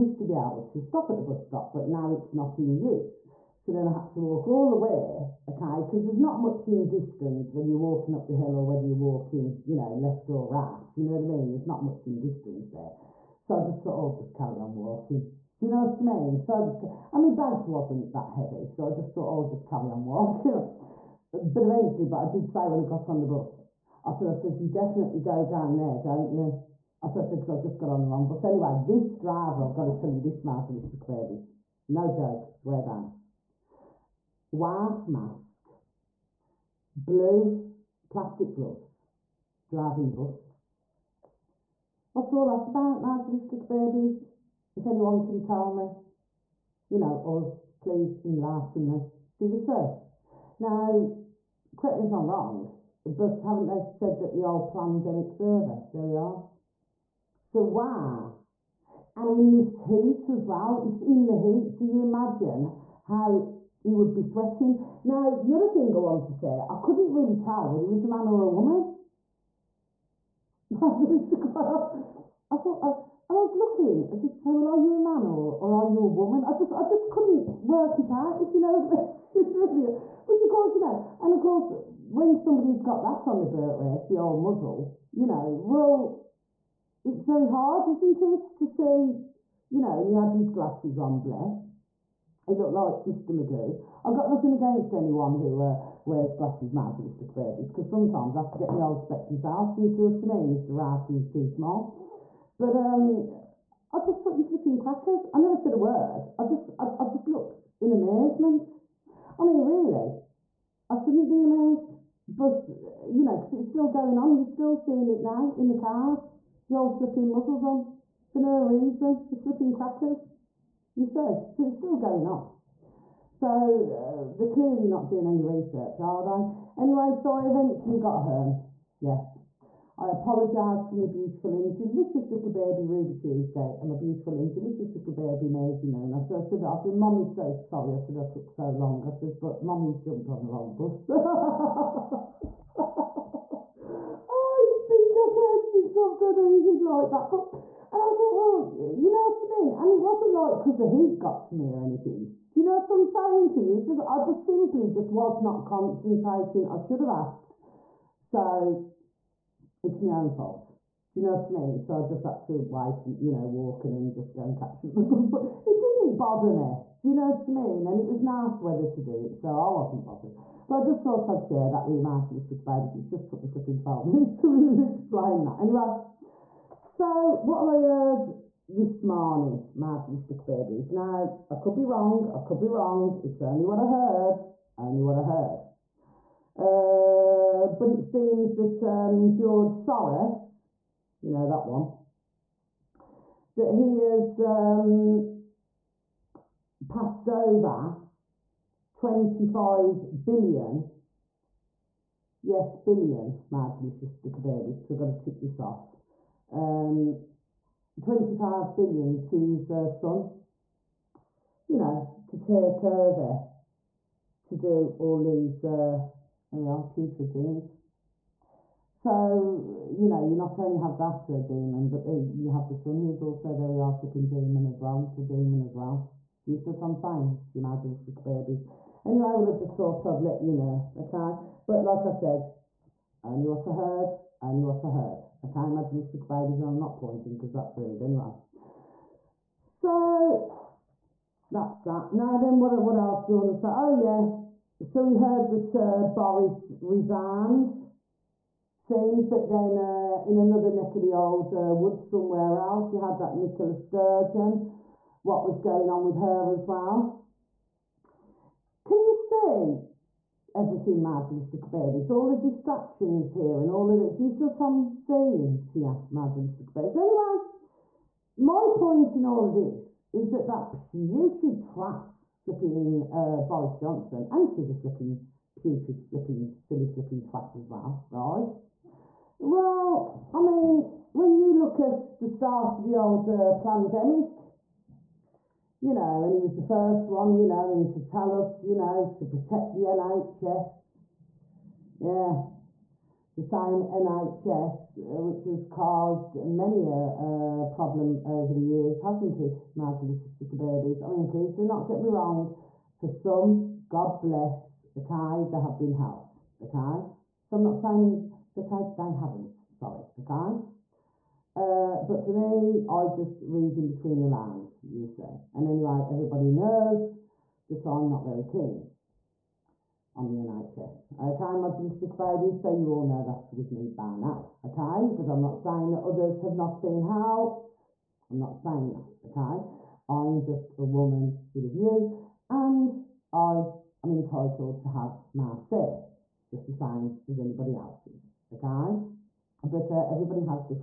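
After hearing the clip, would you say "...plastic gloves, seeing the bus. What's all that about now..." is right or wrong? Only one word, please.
wrong.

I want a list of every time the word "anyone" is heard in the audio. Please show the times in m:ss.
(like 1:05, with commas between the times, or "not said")
0:44, 1:34.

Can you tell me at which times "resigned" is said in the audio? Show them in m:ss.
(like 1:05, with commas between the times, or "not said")
4:06.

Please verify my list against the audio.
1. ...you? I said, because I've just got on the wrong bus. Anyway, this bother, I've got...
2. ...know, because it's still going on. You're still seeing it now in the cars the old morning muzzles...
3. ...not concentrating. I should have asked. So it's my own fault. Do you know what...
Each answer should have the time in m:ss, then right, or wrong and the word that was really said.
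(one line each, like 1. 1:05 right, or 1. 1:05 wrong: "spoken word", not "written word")
1. 0:26 wrong: "driver", not "bother"
2. 1:53 wrong: "flipping", not "morning"
3. 2:35 right.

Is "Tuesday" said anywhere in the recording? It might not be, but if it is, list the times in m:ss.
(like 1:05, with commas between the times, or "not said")
2:13.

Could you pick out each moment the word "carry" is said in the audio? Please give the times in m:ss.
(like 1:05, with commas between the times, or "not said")
0:14, 0:19.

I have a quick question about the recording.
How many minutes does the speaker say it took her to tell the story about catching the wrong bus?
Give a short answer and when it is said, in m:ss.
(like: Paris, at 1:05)
12, at 2:53.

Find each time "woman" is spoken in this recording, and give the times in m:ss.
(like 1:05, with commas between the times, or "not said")
1:08, 1:16, 5:30.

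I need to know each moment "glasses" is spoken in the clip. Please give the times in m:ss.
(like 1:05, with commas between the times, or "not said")
1:30, 1:36.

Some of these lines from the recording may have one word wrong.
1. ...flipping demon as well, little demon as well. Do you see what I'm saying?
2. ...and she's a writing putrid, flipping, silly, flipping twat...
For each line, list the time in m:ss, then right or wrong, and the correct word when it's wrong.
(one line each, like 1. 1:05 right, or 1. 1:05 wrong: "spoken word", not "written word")
1. 3:43 right
2. 4:34 wrong: "flipping", not "writing".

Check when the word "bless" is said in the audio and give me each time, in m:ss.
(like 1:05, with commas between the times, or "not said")
1:31, 5:04.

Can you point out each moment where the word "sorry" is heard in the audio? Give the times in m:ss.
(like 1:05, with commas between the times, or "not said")
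2:17, 5:09.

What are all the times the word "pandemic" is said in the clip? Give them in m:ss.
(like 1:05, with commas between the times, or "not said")
0:54, 4:43.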